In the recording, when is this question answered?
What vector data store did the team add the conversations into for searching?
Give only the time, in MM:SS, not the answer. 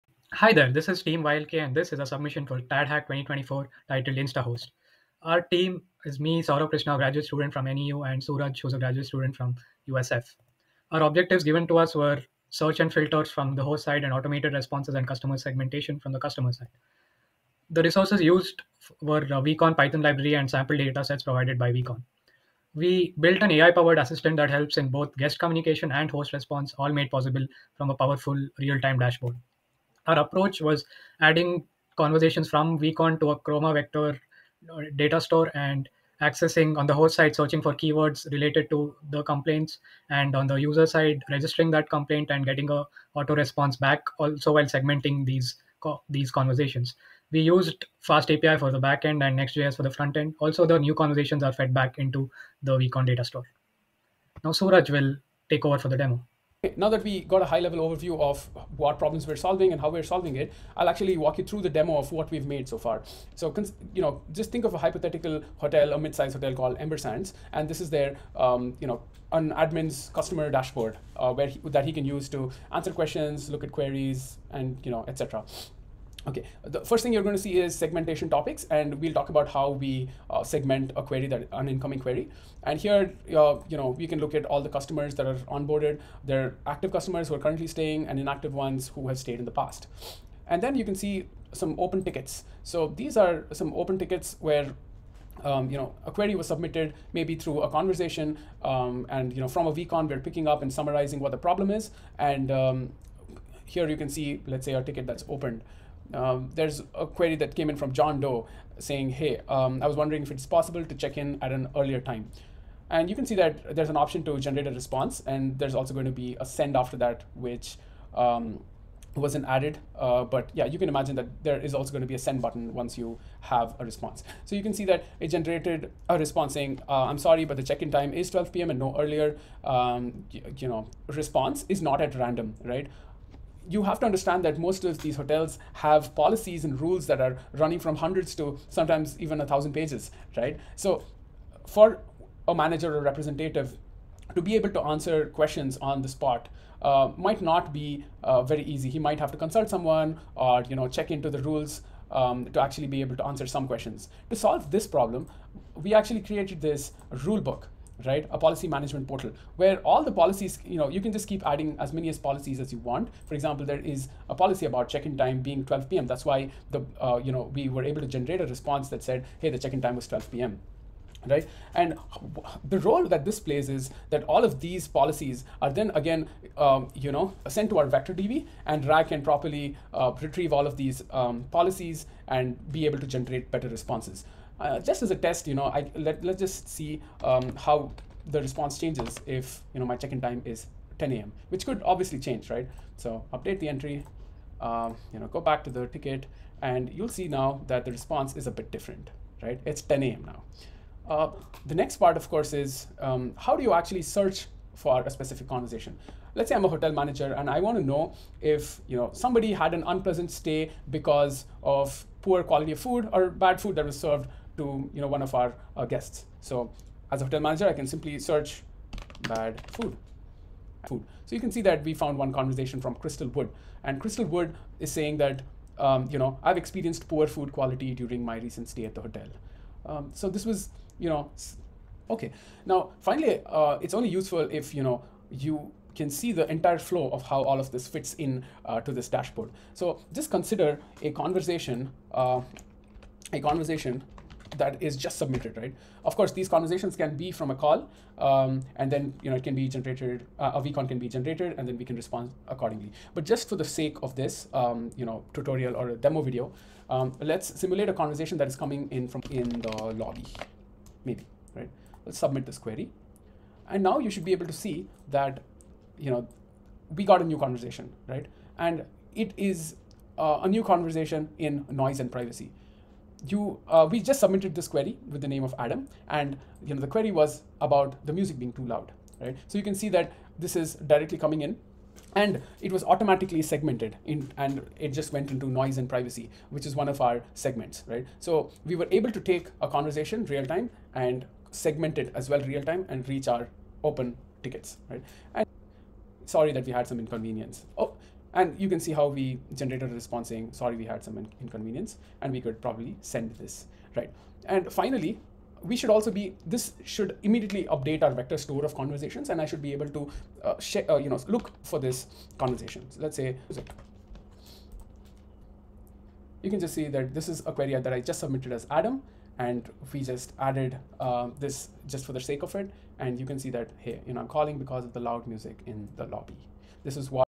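00:33.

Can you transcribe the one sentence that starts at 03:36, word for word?
So as a hotel manager, I can simply search bad food.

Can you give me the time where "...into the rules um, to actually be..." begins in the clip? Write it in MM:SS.
02:31.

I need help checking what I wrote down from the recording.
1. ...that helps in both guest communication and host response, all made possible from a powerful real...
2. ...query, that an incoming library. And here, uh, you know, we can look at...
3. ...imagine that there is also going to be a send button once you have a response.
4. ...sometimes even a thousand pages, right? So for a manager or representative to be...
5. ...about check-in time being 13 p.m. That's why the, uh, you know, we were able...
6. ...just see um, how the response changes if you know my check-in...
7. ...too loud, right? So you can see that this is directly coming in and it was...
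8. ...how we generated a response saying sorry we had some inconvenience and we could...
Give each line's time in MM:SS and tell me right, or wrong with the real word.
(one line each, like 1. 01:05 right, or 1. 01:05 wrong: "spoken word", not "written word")
1. 00:24 right
2. 01:21 wrong: "query", not "library"
3. 02:00 right
4. 02:18 right
5. 02:44 wrong: "12", not "13"
6. 03:06 right
7. 04:38 right
8. 04:58 right.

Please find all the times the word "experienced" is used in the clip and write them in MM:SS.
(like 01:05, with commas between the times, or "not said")
03:46.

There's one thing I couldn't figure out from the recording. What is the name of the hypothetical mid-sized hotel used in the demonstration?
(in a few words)
Ember Sands.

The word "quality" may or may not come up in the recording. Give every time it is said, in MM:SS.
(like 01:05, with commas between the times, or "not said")
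03:32, 03:47.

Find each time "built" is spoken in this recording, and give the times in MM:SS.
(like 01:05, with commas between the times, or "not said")
00:23.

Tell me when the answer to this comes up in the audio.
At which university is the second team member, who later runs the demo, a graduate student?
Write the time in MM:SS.
00:09.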